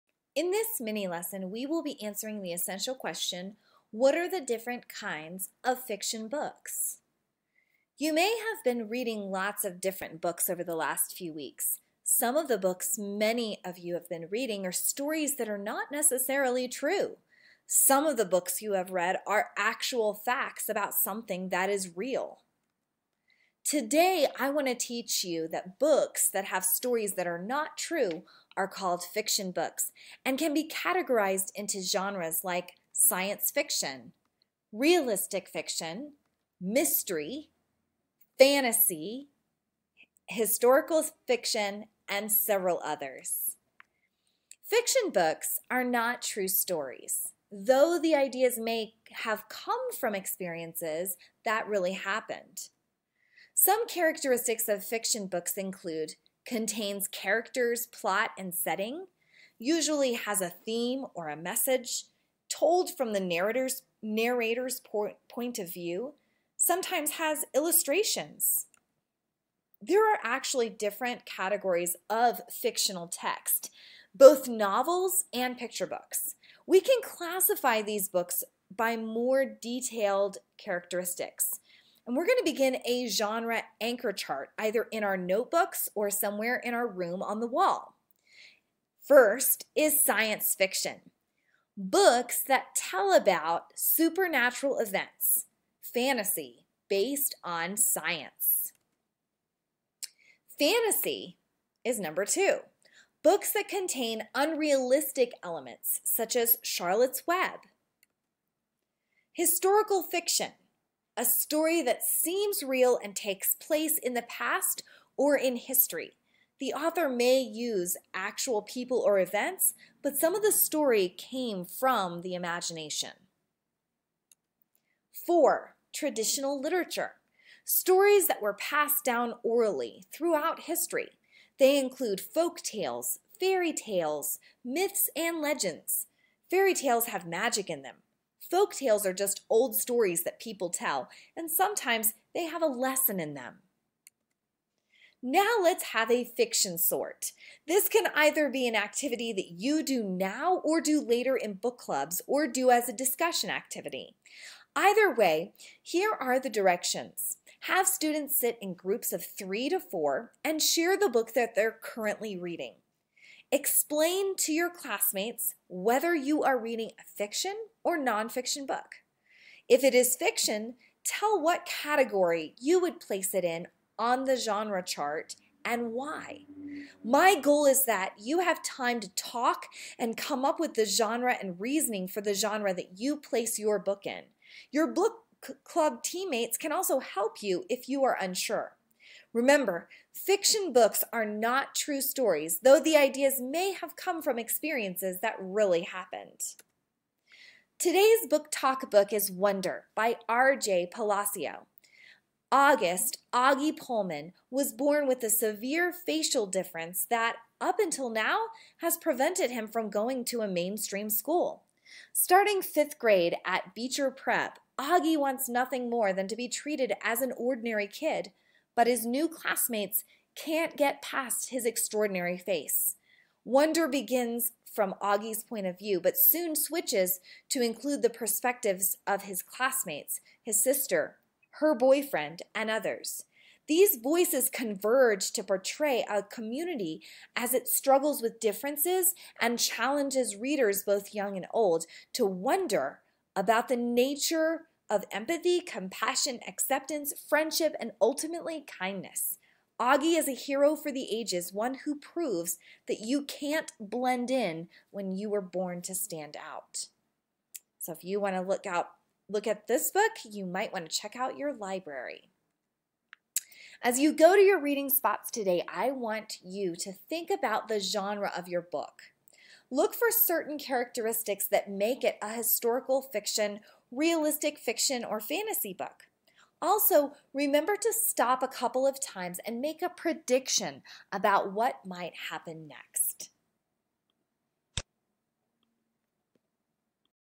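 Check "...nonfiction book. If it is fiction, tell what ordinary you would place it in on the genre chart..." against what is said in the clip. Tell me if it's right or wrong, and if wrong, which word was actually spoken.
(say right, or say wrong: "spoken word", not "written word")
wrong: "category", not "ordinary".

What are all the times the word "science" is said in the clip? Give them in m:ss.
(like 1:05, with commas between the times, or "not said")
0:32, 1:30, 1:37.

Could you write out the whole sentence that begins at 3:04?
Your book club teammates can also help you if you are unsure.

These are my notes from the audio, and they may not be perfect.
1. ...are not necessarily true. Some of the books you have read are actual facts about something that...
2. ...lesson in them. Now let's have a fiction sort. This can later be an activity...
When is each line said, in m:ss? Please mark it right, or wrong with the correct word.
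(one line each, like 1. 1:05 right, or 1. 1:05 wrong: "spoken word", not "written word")
1. 0:15 right
2. 2:22 wrong: "either", not "later".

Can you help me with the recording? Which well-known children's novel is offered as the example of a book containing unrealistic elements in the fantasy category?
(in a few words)
Charlotte's Web.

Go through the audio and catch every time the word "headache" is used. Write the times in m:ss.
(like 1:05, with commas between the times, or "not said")
not said.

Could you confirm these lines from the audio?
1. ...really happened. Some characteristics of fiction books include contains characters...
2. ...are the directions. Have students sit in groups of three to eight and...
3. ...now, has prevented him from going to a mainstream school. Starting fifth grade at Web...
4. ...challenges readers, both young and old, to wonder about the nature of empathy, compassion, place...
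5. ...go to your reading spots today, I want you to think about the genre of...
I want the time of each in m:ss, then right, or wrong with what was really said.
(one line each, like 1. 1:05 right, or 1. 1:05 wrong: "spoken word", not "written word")
1. 0:51 right
2. 2:36 wrong: "four", not "eight"
3. 3:28 wrong: "Beecher", not "Web"
4. 3:59 wrong: "acceptance", not "place"
5. 4:24 right.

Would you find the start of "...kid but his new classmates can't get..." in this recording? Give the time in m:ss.
3:37.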